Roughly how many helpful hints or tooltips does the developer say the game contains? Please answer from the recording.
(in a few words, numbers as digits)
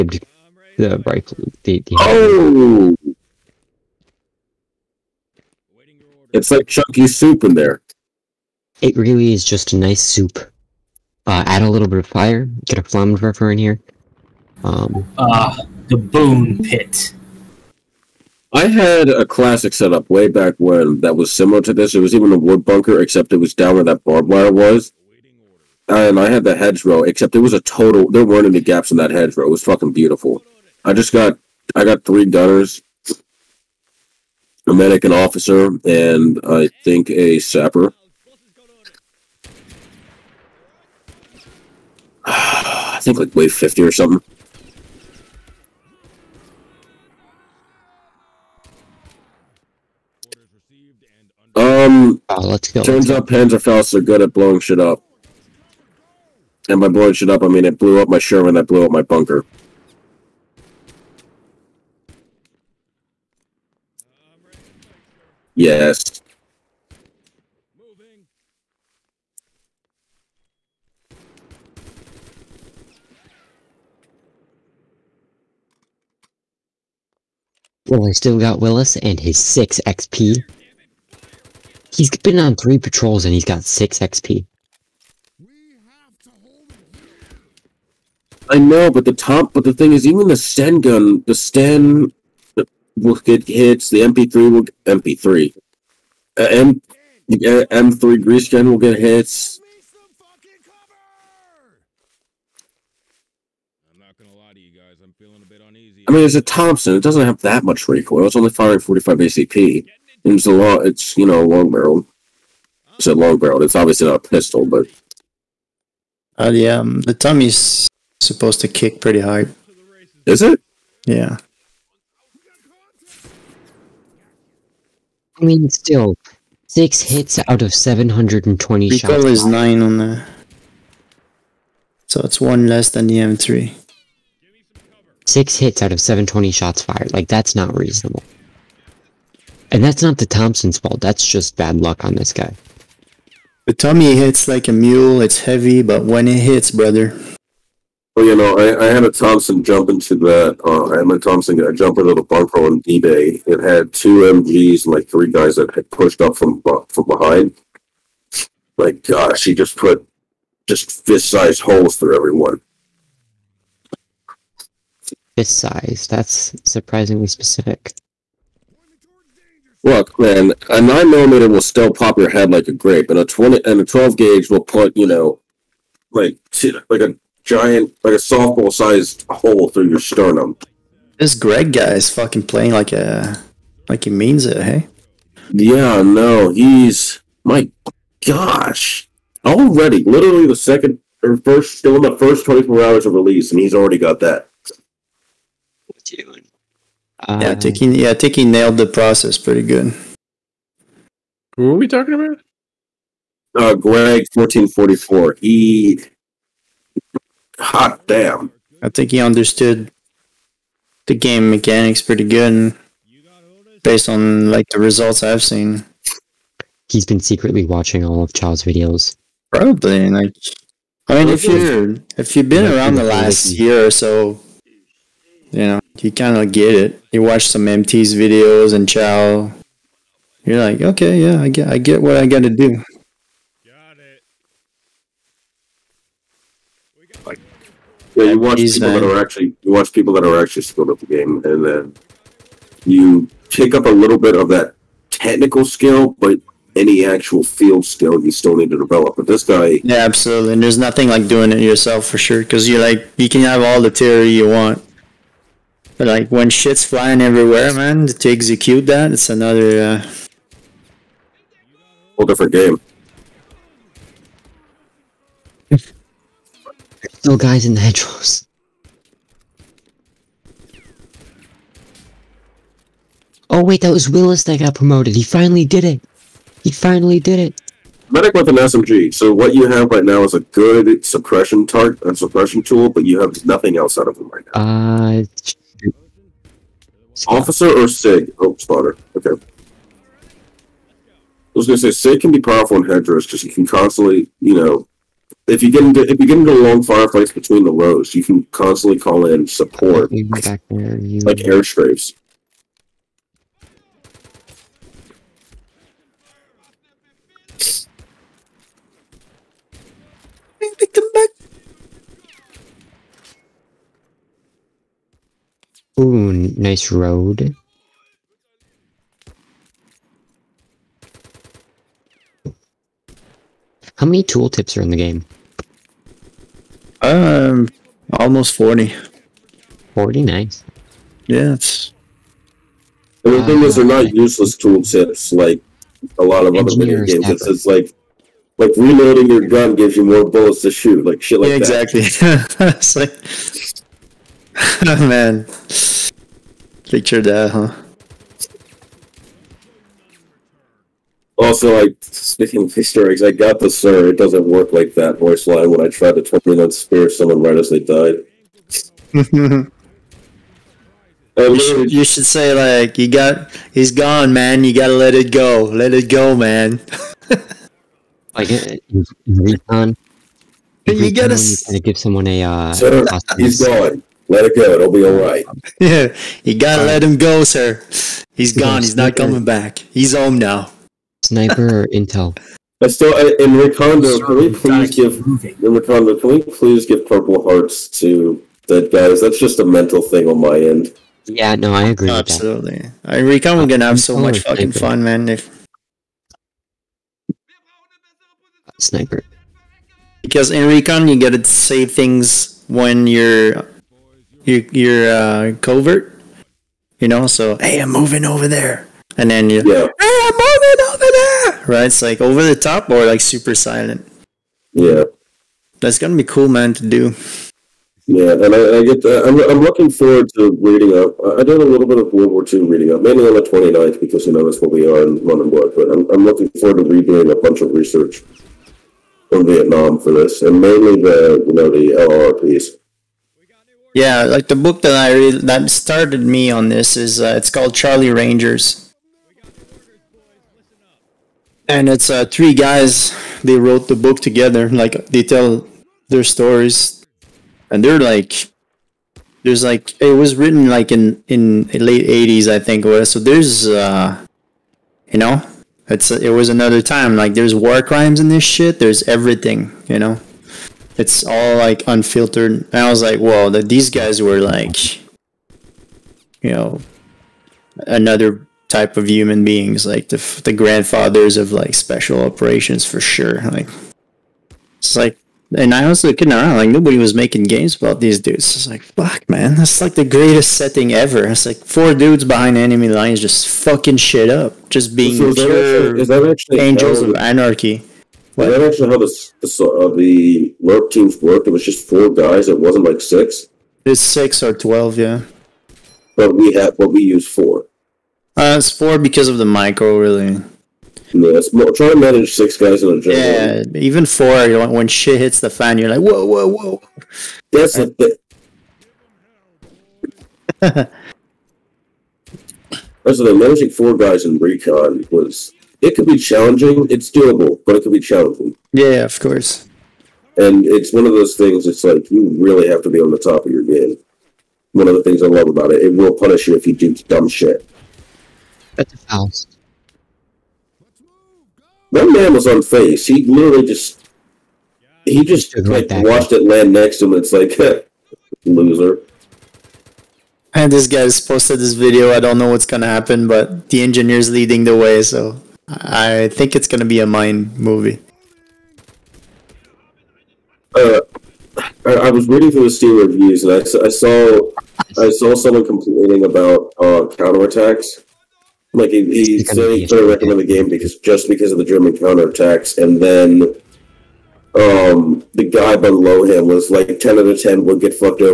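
almost 40.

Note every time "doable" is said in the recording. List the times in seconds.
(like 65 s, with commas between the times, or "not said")
517 s.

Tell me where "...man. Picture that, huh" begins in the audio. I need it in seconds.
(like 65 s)
345 s.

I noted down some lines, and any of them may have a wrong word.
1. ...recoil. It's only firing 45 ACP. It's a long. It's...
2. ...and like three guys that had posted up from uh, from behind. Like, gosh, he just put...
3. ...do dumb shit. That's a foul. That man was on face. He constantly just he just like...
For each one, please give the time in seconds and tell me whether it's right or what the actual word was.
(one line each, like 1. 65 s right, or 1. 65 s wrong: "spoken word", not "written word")
1. 107 s right
2. 154 s wrong: "pushed", not "posted"
3. 526 s wrong: "literally", not "constantly".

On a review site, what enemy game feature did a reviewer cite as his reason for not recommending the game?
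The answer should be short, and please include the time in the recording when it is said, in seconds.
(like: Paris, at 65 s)
German counterattacks, at 561 s.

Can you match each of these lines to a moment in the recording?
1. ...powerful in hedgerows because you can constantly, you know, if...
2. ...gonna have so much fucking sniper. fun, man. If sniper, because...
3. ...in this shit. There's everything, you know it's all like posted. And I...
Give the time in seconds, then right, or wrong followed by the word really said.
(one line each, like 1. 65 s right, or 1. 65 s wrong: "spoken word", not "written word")
1. 292 s right
2. 393 s right
3. 458 s wrong: "unfiltered", not "posted".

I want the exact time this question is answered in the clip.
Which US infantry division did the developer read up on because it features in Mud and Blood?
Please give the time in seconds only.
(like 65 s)
423 s.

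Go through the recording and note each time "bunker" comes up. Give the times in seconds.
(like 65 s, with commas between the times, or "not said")
22 s, 59 s, 152 s.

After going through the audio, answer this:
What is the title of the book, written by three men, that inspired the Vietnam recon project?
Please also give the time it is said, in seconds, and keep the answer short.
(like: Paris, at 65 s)
Charlie Rangers, at 437 s.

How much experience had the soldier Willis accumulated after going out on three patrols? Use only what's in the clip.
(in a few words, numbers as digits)
6 XP.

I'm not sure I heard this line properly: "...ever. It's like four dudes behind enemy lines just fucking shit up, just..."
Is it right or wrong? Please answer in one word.
right.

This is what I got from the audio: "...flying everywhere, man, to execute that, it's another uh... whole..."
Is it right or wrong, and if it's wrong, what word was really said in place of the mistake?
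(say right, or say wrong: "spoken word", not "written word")
right.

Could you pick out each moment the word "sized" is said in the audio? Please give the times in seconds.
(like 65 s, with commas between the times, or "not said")
161 s, 165 s, 178 s.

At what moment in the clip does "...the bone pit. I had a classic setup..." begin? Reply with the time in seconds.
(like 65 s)
15 s.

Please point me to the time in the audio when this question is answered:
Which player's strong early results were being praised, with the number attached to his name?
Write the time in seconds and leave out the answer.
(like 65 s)
203 s.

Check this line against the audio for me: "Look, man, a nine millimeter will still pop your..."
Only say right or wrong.
right.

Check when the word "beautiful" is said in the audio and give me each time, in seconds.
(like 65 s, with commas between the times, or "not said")
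29 s.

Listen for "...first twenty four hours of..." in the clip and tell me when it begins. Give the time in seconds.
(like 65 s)
192 s.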